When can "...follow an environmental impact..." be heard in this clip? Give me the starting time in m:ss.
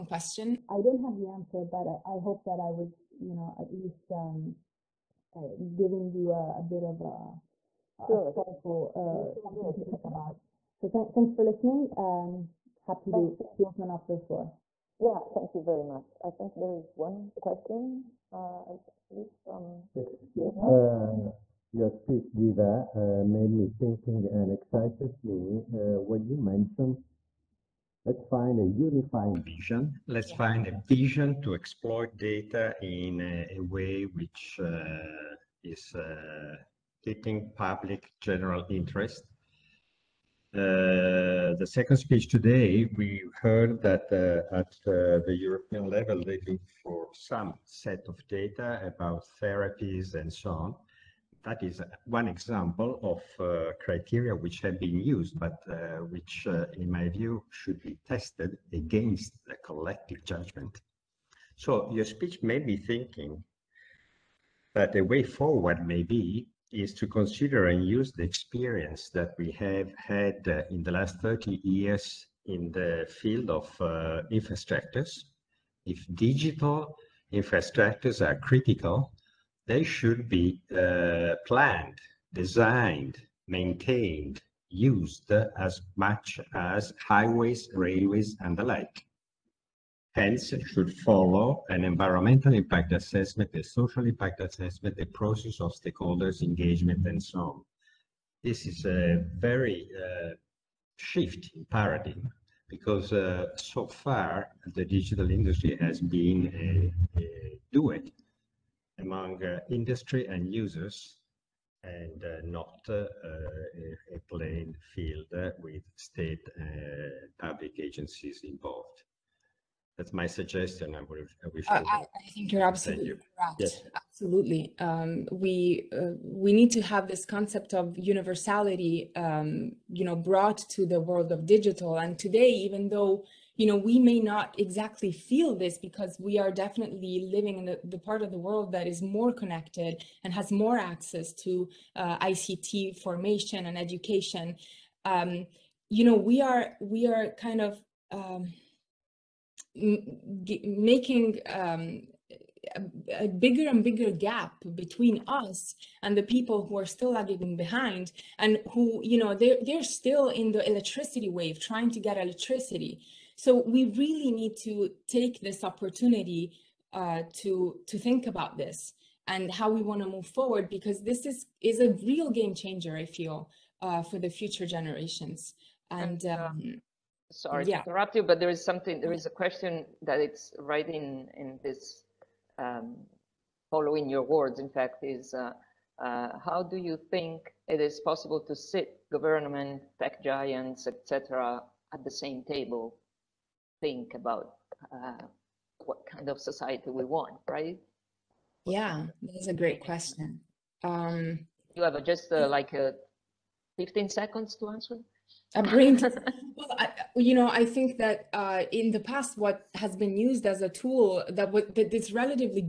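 1:30.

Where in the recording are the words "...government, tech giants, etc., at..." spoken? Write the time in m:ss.
3:09.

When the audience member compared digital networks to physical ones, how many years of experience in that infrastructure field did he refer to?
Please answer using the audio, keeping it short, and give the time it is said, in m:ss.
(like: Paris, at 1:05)
30, at 1:11.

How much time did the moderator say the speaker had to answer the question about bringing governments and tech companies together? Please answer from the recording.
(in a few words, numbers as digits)
15 seconds.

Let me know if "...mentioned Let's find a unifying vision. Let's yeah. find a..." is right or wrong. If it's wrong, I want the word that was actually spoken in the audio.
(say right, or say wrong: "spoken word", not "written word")
right.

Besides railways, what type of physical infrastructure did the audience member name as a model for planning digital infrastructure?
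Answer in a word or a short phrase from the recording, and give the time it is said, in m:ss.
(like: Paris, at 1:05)
Highways, at 1:27.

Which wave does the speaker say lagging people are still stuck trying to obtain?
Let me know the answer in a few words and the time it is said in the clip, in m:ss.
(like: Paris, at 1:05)
The electricity wave, at 2:40.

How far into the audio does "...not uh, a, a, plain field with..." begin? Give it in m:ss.
1:52.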